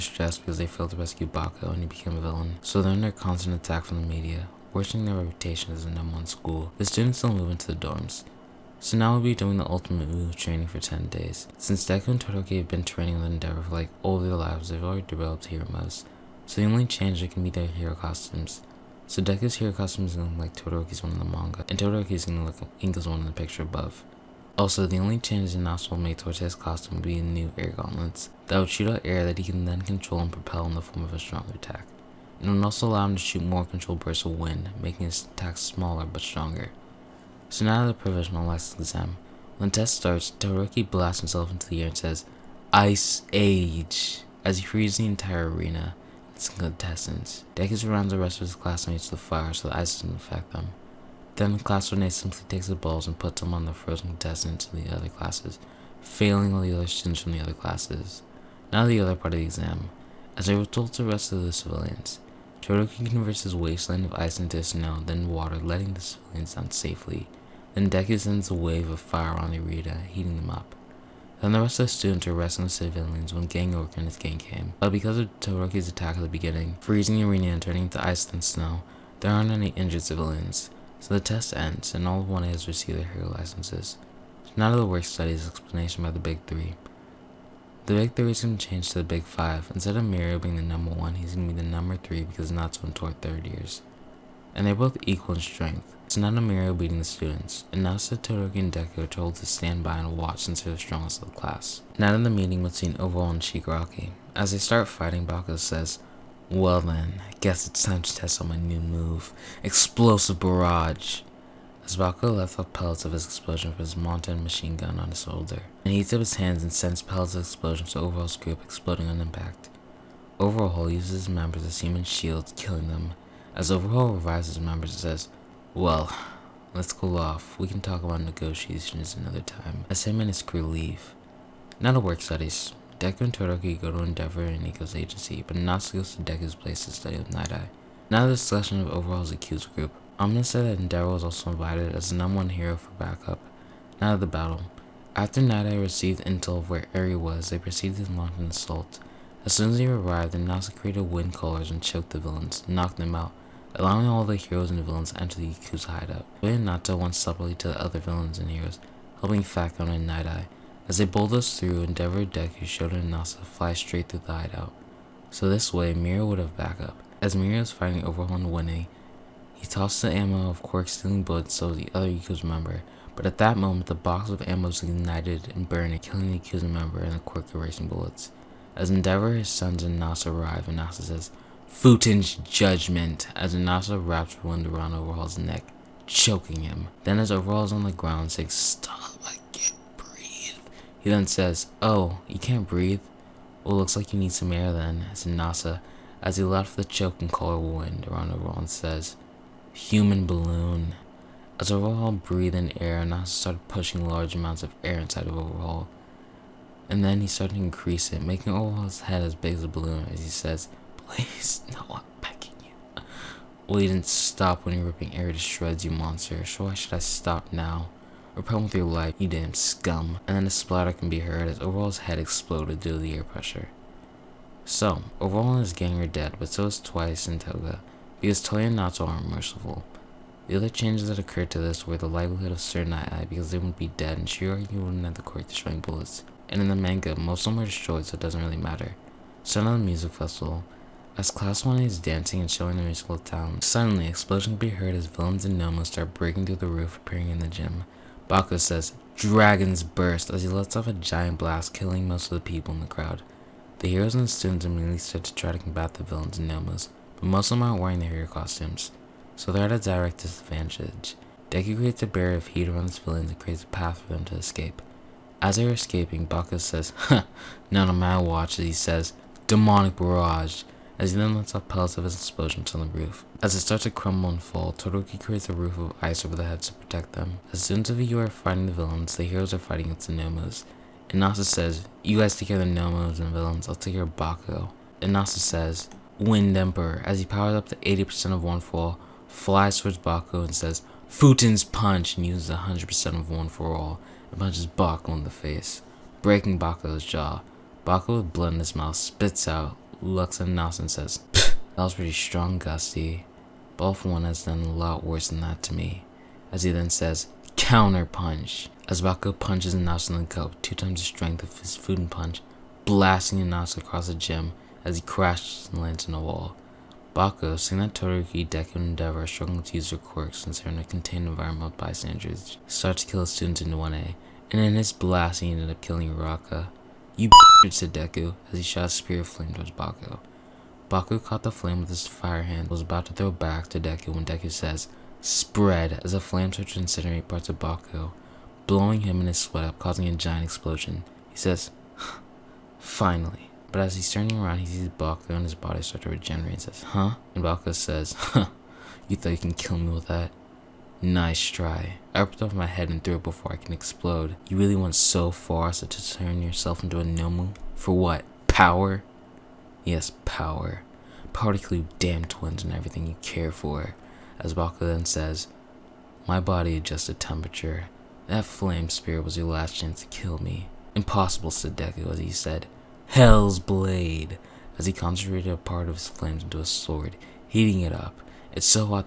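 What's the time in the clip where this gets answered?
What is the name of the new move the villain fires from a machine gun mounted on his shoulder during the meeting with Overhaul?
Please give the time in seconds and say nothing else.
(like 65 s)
109 s.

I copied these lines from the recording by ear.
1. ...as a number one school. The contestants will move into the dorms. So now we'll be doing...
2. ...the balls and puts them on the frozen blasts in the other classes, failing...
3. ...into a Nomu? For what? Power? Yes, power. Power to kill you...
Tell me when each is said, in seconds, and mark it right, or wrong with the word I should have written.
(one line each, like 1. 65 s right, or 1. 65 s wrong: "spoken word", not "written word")
1. 5 s wrong: "students", not "contestants"
2. 52 s wrong: "contestants", not "blasts"
3. 356 s right.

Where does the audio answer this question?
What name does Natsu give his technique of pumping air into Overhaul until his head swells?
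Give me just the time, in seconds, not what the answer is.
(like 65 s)
199 s.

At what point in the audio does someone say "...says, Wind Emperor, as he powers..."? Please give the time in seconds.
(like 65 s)
285 s.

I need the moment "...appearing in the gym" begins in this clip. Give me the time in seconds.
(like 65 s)
246 s.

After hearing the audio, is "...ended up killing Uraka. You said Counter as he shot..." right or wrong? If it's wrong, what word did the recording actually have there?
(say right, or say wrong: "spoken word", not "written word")
wrong: "Deku", not "Counter".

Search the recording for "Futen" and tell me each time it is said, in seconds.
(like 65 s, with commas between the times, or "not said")
181 s, 291 s.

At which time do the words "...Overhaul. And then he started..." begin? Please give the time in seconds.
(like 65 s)
205 s.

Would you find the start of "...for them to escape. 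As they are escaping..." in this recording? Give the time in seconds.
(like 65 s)
264 s.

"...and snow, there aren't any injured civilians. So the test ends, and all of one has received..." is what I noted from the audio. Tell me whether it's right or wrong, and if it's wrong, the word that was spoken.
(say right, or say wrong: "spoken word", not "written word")
right.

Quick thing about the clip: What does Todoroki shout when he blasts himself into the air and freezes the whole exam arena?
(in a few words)
Ice Age.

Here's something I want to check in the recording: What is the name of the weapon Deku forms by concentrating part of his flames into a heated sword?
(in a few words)
Hell's Blade.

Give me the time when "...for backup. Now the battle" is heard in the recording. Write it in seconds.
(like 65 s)
142 s.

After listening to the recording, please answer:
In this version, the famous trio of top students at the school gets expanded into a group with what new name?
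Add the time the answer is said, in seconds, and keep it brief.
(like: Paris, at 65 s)
Big Five, at 89 s.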